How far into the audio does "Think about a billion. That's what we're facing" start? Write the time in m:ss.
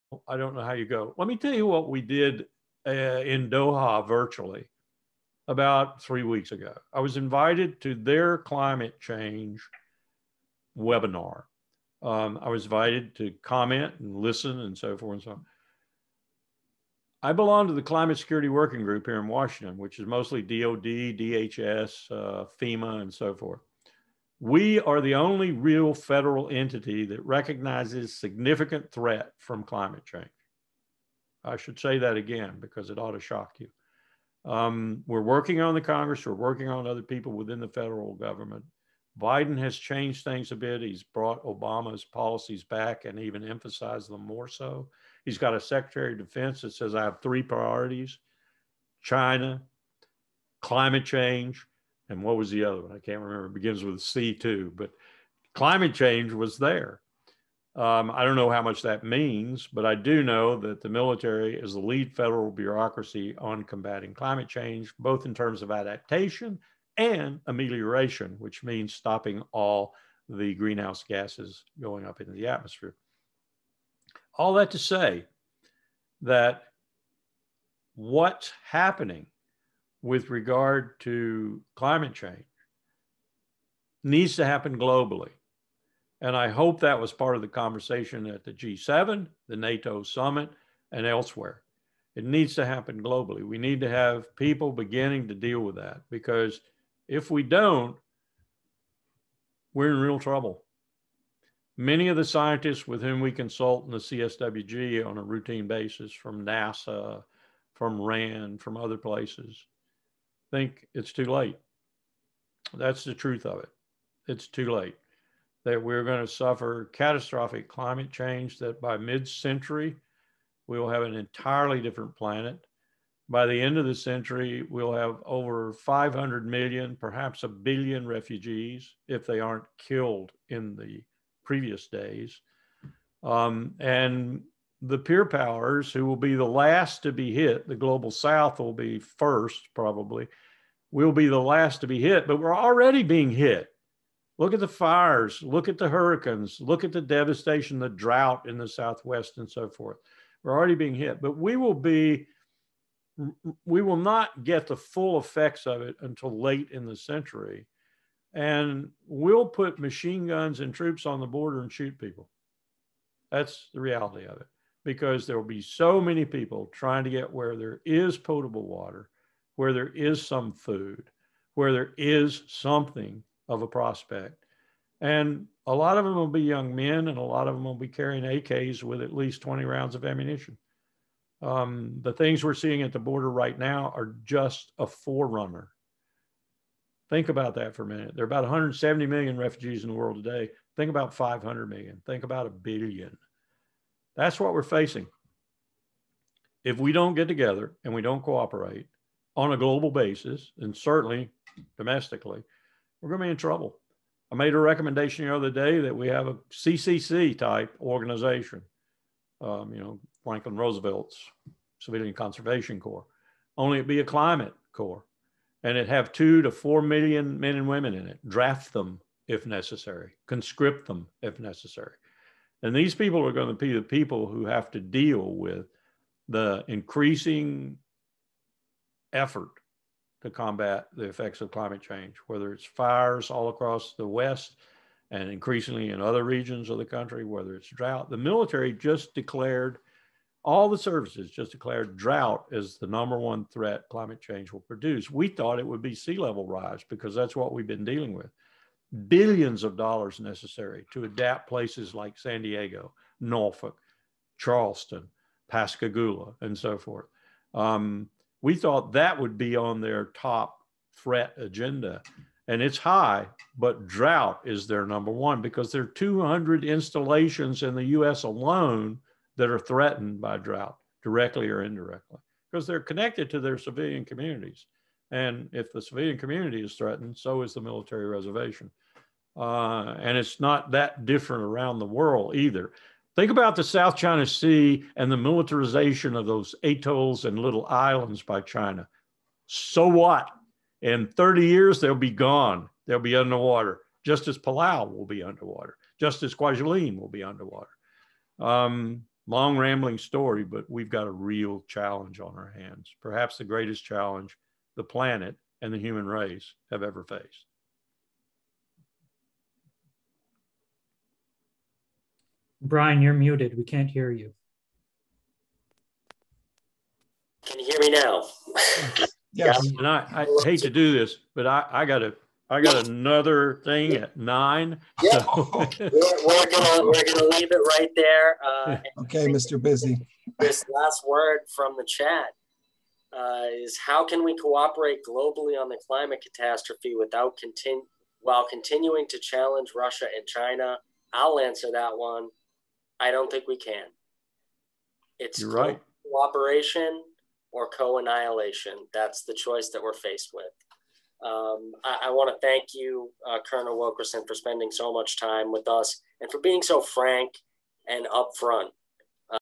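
3:12.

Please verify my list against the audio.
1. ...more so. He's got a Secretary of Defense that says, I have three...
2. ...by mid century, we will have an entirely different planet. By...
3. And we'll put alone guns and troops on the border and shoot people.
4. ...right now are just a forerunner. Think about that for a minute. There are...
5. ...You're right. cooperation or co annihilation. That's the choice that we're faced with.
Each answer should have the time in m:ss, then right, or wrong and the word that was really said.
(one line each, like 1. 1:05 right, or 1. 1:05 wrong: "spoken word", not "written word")
1. 0:44 right
2. 1:58 right
3. 2:38 wrong: "machine", not "alone"
4. 3:03 right
5. 5:45 right.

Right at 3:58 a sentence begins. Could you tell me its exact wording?
The military just declared, all the services just declared drought as the number one threat climate change will produce.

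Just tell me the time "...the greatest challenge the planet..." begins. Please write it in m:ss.
5:03.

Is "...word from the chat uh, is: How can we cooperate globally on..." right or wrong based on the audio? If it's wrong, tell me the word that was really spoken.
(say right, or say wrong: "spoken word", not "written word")
right.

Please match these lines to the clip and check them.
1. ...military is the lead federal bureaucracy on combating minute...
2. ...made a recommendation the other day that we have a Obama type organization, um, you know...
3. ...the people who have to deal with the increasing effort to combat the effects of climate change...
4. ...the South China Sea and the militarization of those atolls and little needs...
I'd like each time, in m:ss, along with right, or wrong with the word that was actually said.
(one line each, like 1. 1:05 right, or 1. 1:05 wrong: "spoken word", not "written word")
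1. 1:00 wrong: "climate", not "minute"
2. 3:24 wrong: "CCC", not "Obama"
3. 3:43 right
4. 4:43 wrong: "islands", not "needs".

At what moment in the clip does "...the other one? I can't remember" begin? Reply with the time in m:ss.
0:52.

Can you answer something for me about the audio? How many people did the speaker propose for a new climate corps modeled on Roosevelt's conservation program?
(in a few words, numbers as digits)
2 to 4 million.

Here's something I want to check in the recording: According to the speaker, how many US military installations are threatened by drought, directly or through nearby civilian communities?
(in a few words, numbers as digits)
200.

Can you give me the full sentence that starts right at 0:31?
I should say that again because it ought to shock you.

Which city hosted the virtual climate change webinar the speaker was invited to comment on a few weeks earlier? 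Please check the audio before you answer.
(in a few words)
Doha.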